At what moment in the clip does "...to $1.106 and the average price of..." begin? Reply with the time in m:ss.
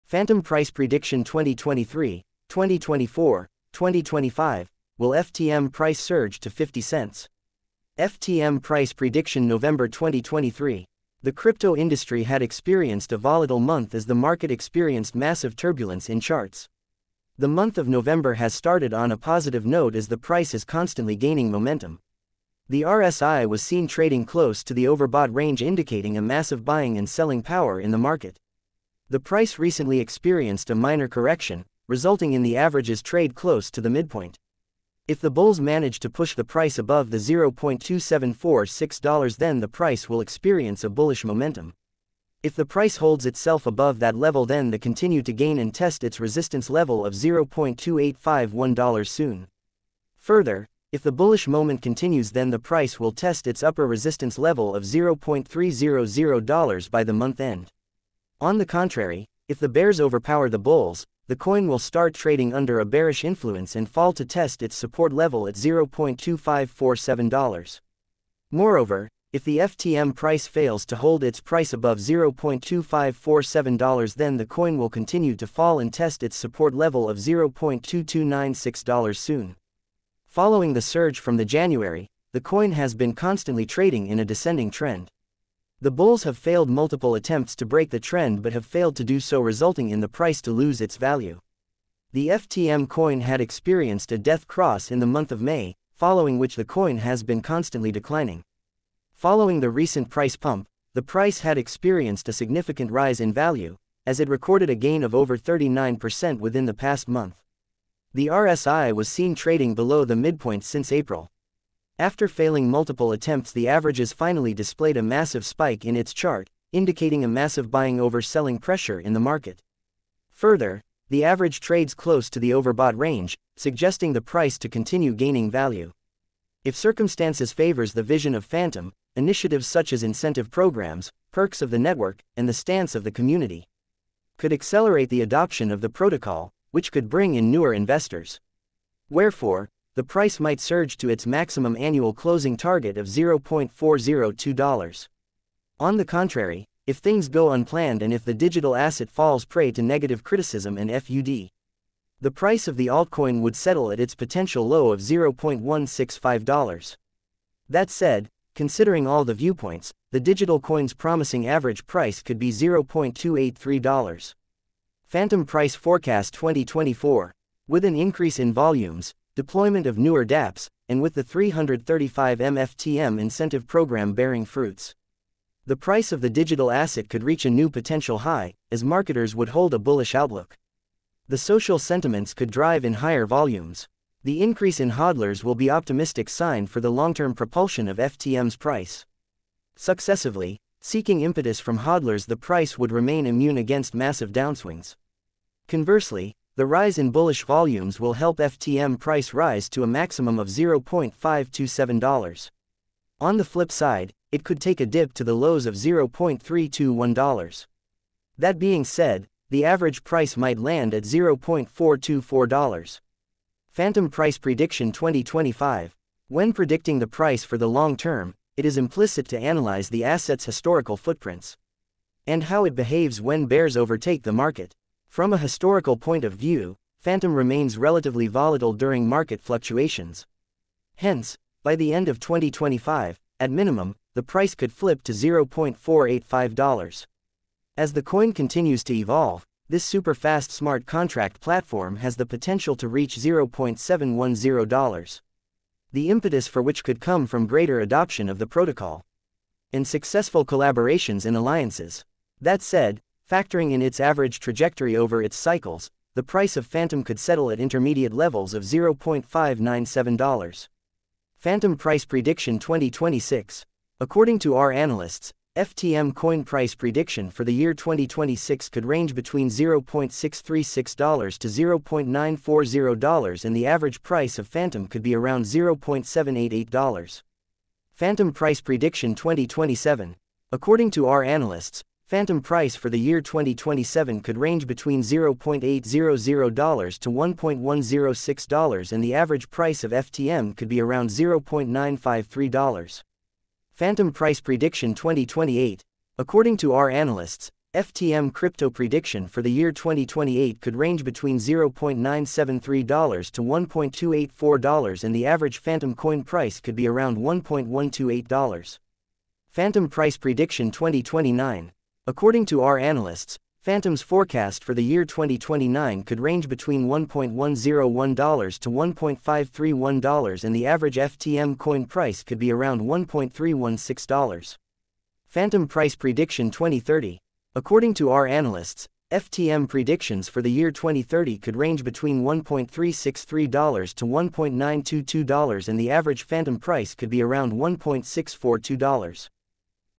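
4:46.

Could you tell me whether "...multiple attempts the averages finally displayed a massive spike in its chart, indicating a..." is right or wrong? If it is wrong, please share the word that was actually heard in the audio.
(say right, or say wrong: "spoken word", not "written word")
right.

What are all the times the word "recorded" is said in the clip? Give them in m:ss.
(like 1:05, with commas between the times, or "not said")
1:44.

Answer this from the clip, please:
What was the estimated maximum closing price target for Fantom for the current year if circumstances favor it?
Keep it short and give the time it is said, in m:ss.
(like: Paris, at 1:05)
$0.402, at 2:23.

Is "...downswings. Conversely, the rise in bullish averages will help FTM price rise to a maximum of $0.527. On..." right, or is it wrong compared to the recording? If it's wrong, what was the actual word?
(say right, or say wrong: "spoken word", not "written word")
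wrong: "volumes", not "averages".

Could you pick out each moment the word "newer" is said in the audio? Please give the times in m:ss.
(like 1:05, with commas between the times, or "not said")
2:17, 2:49.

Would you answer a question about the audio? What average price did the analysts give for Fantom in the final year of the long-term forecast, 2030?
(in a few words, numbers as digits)
$1.642.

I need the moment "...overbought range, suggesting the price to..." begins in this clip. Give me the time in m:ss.
2:02.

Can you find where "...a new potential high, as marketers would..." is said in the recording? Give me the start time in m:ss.
2:57.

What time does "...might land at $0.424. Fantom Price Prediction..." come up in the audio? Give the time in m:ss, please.
3:30.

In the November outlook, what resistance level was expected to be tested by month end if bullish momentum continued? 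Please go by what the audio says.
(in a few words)
$0.300.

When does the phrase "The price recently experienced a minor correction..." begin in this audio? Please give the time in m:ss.
0:29.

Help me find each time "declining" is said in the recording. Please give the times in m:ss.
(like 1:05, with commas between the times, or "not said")
1:37.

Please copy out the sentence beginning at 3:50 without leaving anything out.
Hence, by the end of 2025, at minimum, the price could flip to $0.485.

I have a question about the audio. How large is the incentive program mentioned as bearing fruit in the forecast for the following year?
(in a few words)
335 MFTM.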